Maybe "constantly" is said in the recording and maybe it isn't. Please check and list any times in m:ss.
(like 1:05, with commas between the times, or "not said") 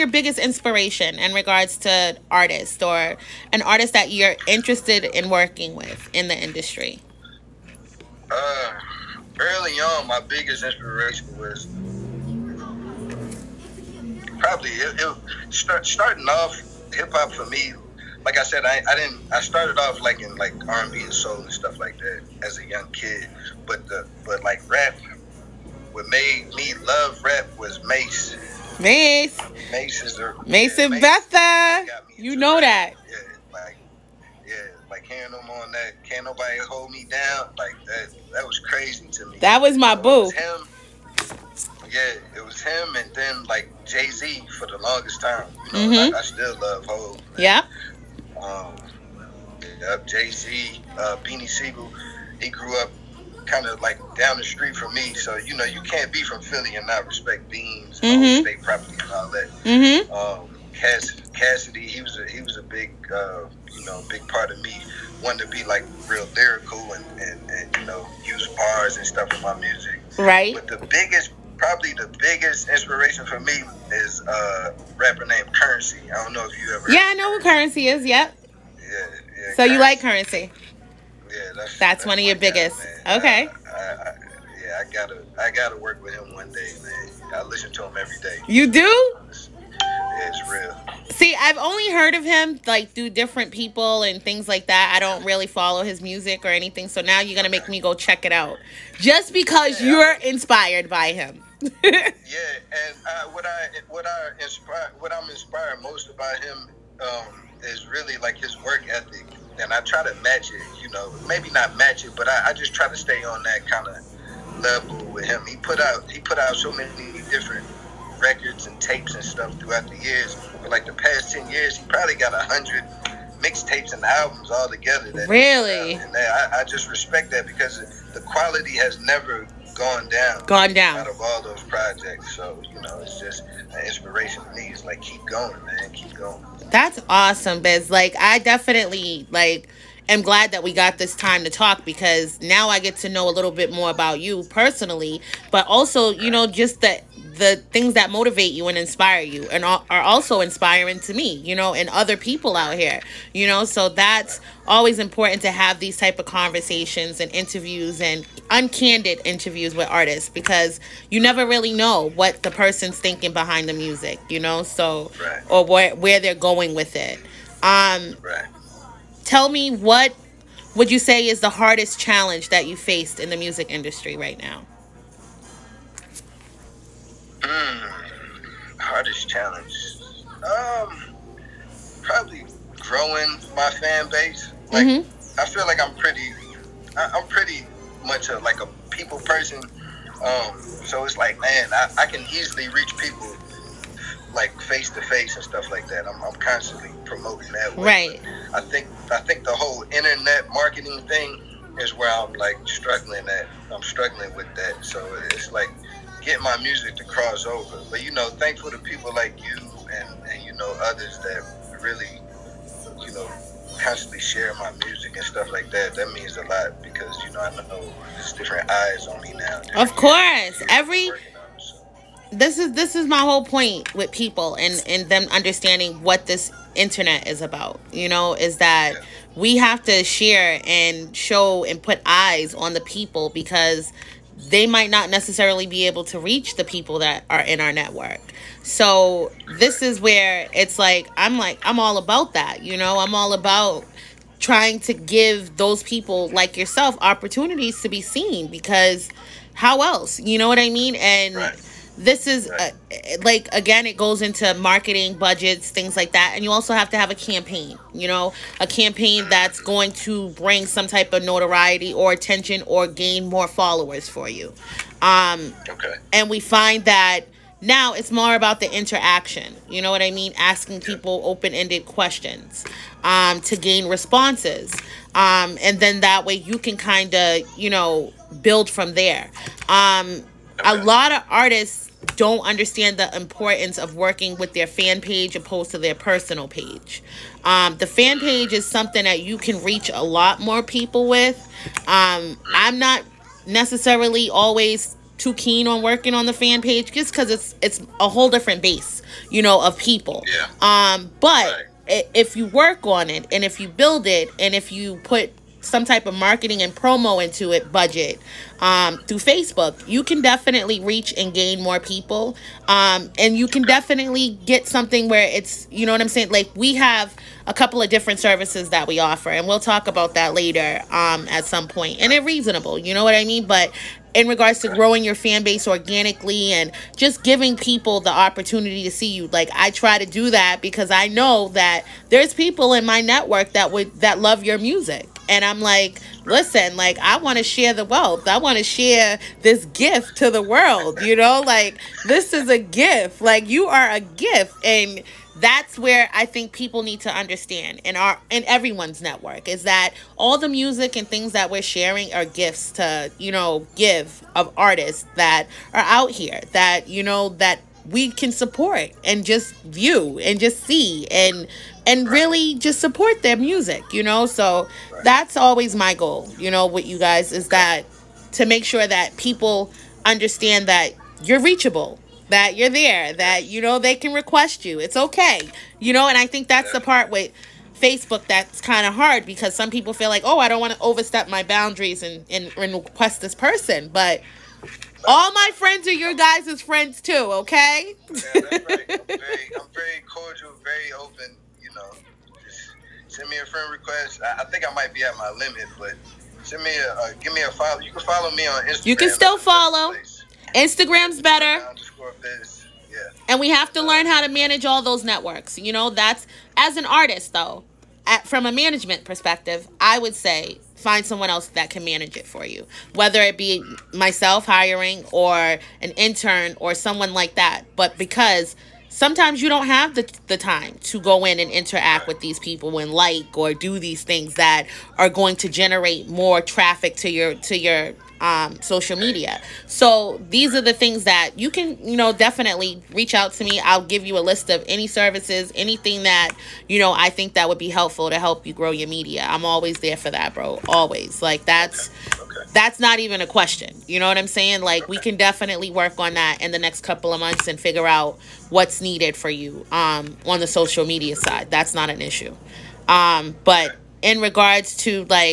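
3:16, 3:33.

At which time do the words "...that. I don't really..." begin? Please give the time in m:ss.
1:34.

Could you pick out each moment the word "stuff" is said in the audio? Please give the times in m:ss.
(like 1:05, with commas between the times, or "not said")
0:21, 1:09, 1:59, 3:15, 3:35.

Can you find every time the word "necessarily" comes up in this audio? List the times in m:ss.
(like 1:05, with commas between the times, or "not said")
3:55, 4:53.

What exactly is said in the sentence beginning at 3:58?
So this is where it's like I'm like I'm all about that, you know?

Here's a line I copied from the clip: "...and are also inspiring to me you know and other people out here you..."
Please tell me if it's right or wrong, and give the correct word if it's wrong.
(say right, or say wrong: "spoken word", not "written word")
right.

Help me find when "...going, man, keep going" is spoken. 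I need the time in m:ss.
2:15.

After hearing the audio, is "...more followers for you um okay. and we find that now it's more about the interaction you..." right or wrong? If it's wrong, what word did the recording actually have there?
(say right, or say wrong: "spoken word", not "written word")
right.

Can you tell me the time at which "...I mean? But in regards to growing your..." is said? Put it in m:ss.
5:23.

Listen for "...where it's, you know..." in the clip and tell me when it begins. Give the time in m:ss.
5:15.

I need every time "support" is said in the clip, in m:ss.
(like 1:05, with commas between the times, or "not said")
5:58, 6:02.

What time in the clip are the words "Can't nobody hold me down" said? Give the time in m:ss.
0:36.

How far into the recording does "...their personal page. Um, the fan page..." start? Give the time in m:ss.
4:45.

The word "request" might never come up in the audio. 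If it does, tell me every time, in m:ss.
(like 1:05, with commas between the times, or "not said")
6:14, 6:22, 6:33.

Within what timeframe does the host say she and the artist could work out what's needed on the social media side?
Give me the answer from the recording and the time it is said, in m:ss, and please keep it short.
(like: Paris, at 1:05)
Next couple of months, at 7:26.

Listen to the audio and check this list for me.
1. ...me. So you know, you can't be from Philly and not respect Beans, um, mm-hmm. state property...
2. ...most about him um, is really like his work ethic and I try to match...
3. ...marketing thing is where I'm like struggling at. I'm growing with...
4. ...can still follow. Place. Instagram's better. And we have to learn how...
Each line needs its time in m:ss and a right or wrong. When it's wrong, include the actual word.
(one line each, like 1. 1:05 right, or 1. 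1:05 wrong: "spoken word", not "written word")
1. 0:54 right
2. 1:45 right
3. 3:20 wrong: "struggling", not "growing"
4. 6:38 right.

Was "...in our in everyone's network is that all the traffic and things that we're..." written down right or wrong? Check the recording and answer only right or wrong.
wrong.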